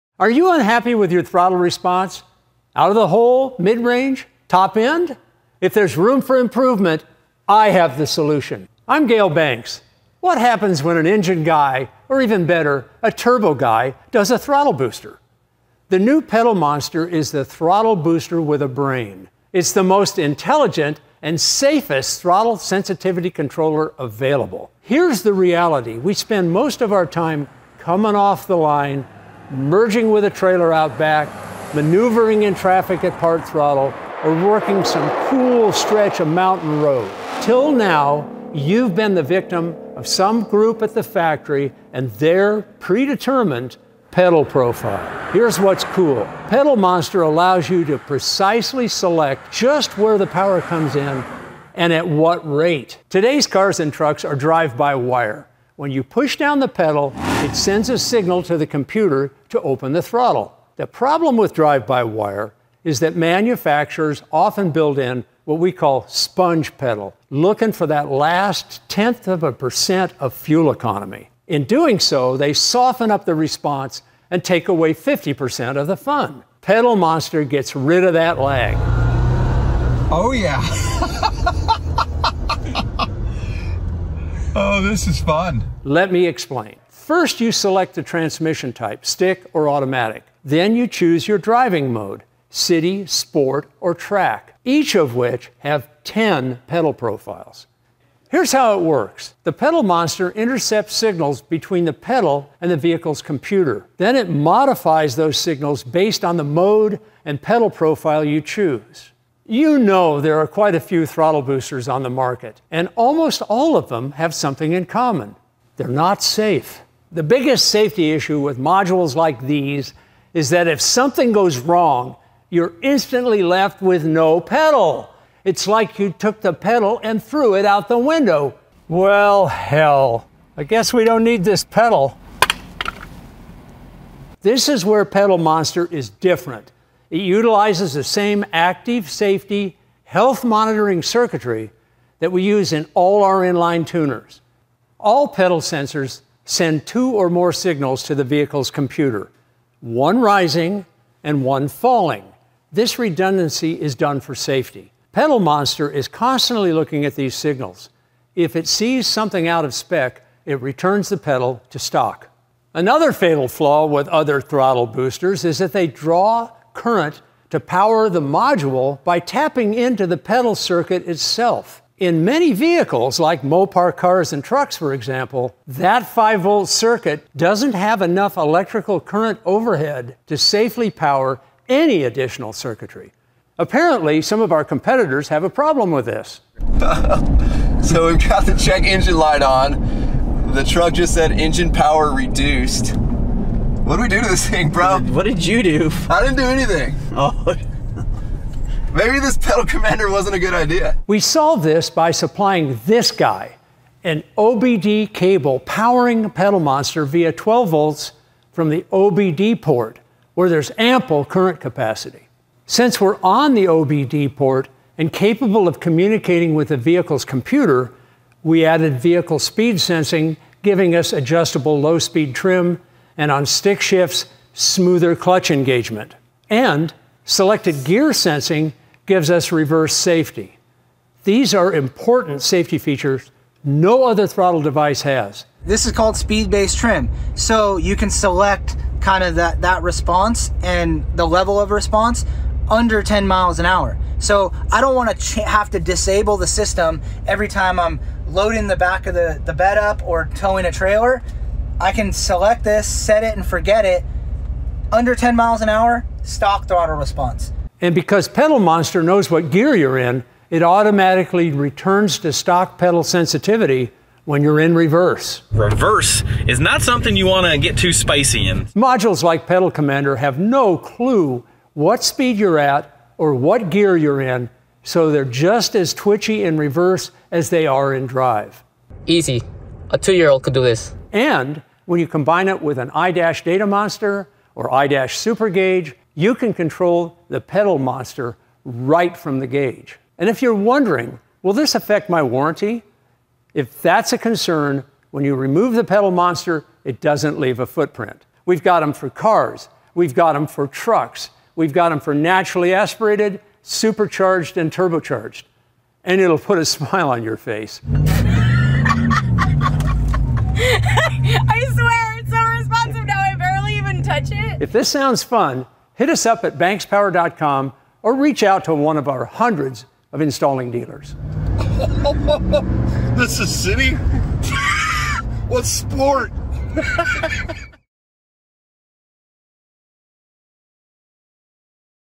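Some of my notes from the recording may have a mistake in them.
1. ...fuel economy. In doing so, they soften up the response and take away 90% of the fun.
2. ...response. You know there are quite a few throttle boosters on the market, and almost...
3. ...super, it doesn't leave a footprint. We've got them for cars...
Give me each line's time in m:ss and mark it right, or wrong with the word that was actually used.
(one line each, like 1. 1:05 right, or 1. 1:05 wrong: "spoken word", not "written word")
1. 1:10 wrong: "50", not "90"
2. 1:48 wrong: "choose", not "response"
3. 4:56 wrong: "monster", not "super".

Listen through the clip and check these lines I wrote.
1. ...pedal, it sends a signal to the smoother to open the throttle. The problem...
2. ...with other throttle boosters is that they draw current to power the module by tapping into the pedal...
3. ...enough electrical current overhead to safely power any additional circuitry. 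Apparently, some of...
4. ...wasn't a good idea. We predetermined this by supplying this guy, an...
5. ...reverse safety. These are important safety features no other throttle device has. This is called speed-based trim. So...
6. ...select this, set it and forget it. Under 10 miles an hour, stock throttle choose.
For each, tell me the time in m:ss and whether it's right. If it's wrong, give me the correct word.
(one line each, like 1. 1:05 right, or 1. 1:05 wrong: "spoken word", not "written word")
1. 0:56 wrong: "computer", not "smoother"
2. 2:43 right
3. 2:58 right
4. 3:20 wrong: "solved", not "predetermined"
5. 3:49 right
6. 4:12 wrong: "response", not "choose".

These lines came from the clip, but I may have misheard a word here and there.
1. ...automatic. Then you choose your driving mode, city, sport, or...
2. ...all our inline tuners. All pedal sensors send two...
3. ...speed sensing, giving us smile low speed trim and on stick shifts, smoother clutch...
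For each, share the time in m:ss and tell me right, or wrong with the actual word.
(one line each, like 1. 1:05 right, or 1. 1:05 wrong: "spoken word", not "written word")
1. 1:29 right
2. 2:22 right
3. 3:39 wrong: "adjustable", not "smile".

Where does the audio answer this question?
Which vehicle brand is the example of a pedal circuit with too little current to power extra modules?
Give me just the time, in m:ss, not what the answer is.
2:53.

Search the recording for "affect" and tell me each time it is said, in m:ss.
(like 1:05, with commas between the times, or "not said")
4:51.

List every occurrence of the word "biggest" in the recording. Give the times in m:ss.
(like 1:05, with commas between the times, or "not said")
1:57.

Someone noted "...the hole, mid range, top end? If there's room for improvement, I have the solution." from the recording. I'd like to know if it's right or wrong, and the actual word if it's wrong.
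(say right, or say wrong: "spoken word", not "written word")
right.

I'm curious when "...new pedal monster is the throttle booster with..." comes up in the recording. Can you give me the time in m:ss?
0:15.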